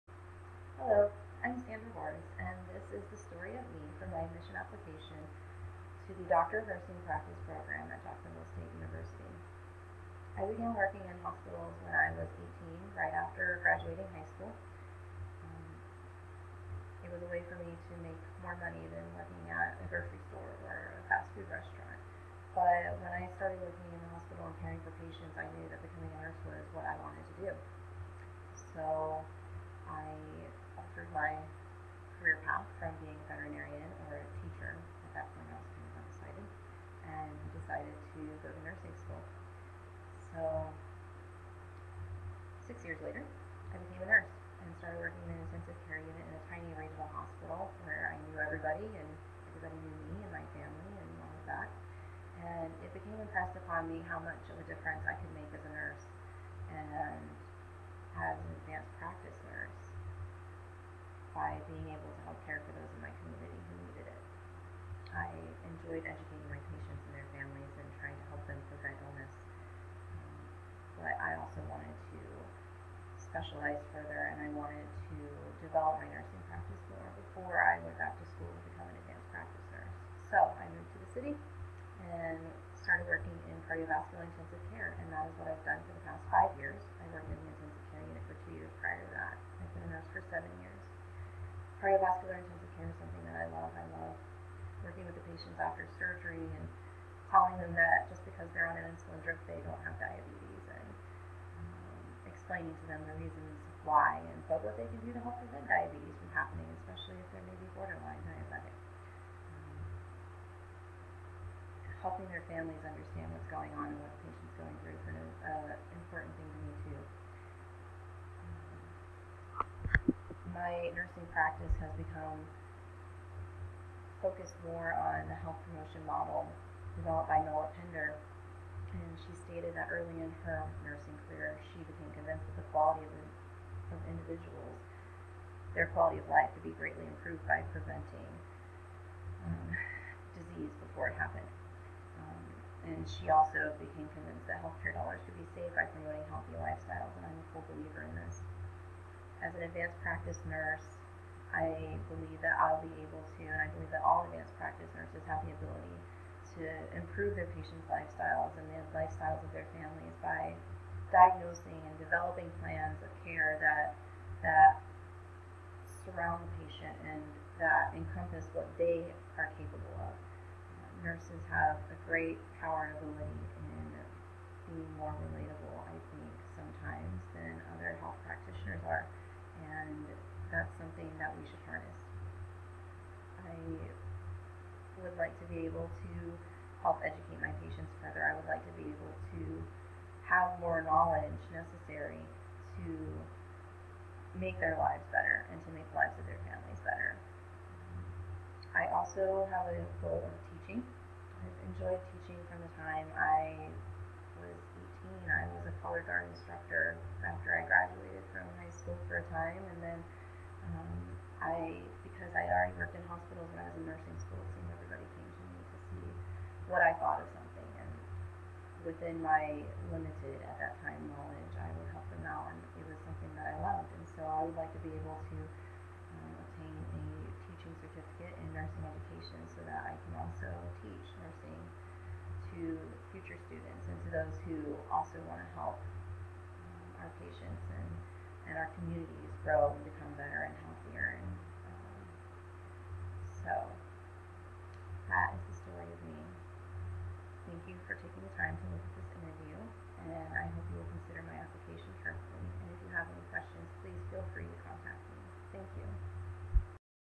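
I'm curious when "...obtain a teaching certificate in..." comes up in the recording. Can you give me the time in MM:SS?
03:46.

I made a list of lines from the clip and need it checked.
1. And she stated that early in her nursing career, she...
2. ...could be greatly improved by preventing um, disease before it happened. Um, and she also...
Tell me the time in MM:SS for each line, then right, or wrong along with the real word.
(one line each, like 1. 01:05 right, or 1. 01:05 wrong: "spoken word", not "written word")
1. 02:08 right
2. 02:16 right.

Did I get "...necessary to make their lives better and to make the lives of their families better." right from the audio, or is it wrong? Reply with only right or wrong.
right.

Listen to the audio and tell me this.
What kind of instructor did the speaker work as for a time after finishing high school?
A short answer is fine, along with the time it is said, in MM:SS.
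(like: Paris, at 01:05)
Color guard instructor, at 03:25.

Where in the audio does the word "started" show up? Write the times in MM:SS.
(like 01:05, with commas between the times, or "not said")
00:23, 00:44, 01:22.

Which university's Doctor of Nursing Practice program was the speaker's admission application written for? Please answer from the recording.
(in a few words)
Jacksonville State University.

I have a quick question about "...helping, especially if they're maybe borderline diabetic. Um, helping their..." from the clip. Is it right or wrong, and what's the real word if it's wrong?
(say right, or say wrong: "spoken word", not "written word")
wrong: "happening", not "helping".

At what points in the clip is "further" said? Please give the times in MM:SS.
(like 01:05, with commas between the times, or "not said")
01:13, 03:08.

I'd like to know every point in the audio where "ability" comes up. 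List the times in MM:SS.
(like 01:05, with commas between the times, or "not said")
02:35, 02:52.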